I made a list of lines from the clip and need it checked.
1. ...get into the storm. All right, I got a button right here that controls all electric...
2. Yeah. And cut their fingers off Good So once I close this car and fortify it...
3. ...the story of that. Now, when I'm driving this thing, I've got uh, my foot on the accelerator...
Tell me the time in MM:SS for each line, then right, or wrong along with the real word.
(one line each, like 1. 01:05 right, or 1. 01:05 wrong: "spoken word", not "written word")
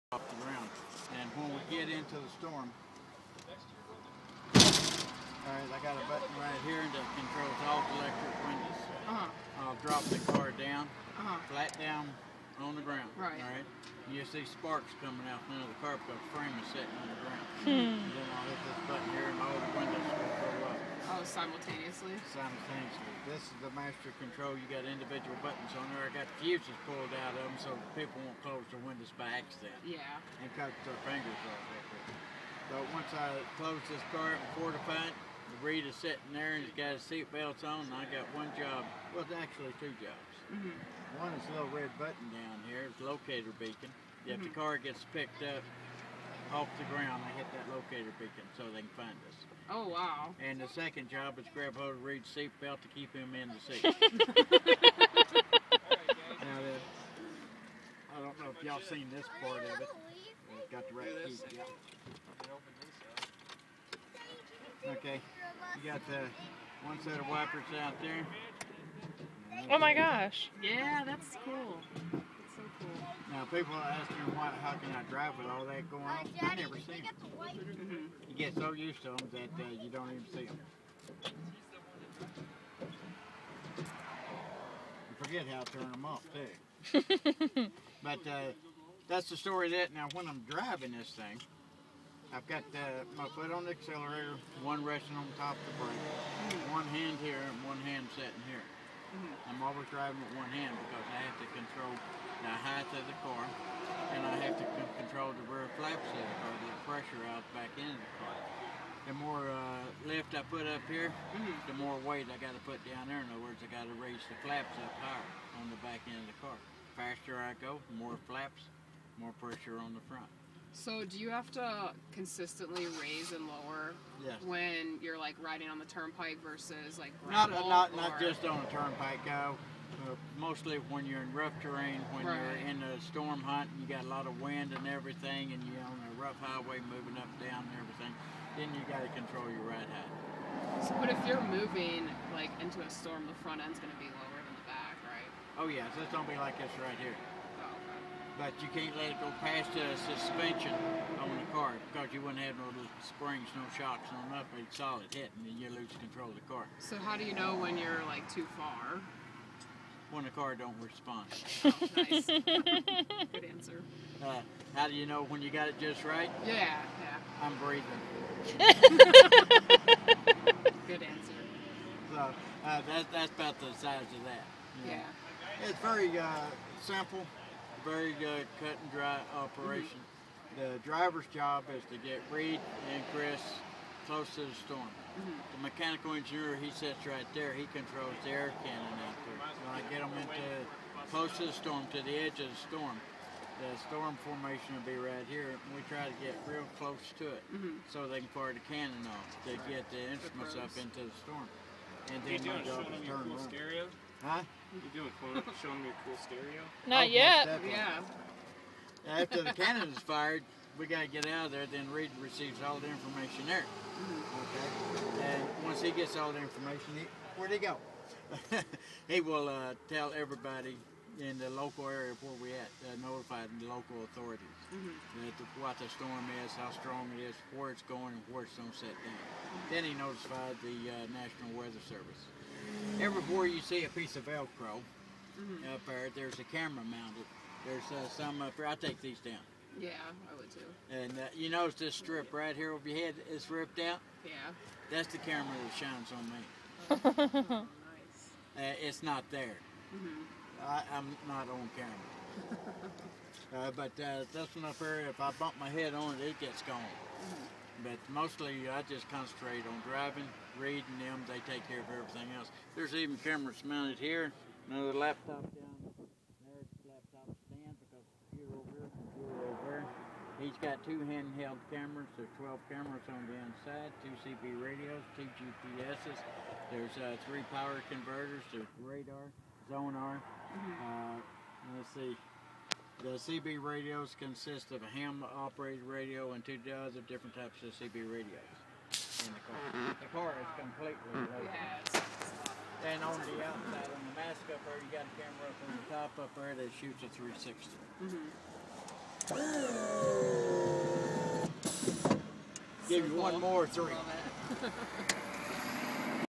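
1. 00:01 right
2. 00:29 wrong: "But", not "Good"
3. 01:29 right.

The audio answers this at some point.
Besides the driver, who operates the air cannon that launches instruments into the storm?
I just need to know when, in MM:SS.
03:05.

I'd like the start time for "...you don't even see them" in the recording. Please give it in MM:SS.
01:19.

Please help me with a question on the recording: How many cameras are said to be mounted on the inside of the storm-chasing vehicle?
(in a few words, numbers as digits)
12.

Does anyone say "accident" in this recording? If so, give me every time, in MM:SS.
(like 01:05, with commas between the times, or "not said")
00:29.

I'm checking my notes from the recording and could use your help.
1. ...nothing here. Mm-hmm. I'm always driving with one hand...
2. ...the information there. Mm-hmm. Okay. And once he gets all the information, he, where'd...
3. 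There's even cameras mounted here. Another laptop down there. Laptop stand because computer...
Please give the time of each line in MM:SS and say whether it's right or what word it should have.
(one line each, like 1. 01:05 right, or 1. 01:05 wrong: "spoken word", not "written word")
1. 01:38 wrong: "sitting", not "nothing"
2. 03:32 right
3. 04:22 right.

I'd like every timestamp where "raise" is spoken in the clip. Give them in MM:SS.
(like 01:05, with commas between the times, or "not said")
01:53, 02:02.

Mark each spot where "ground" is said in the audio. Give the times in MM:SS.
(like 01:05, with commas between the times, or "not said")
00:12, 00:17, 00:46.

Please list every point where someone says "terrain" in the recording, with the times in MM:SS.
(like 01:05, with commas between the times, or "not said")
02:11.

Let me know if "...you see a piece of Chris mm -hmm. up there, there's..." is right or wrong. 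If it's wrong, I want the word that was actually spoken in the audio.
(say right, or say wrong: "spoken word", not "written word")
wrong: "Velcro", not "Chris".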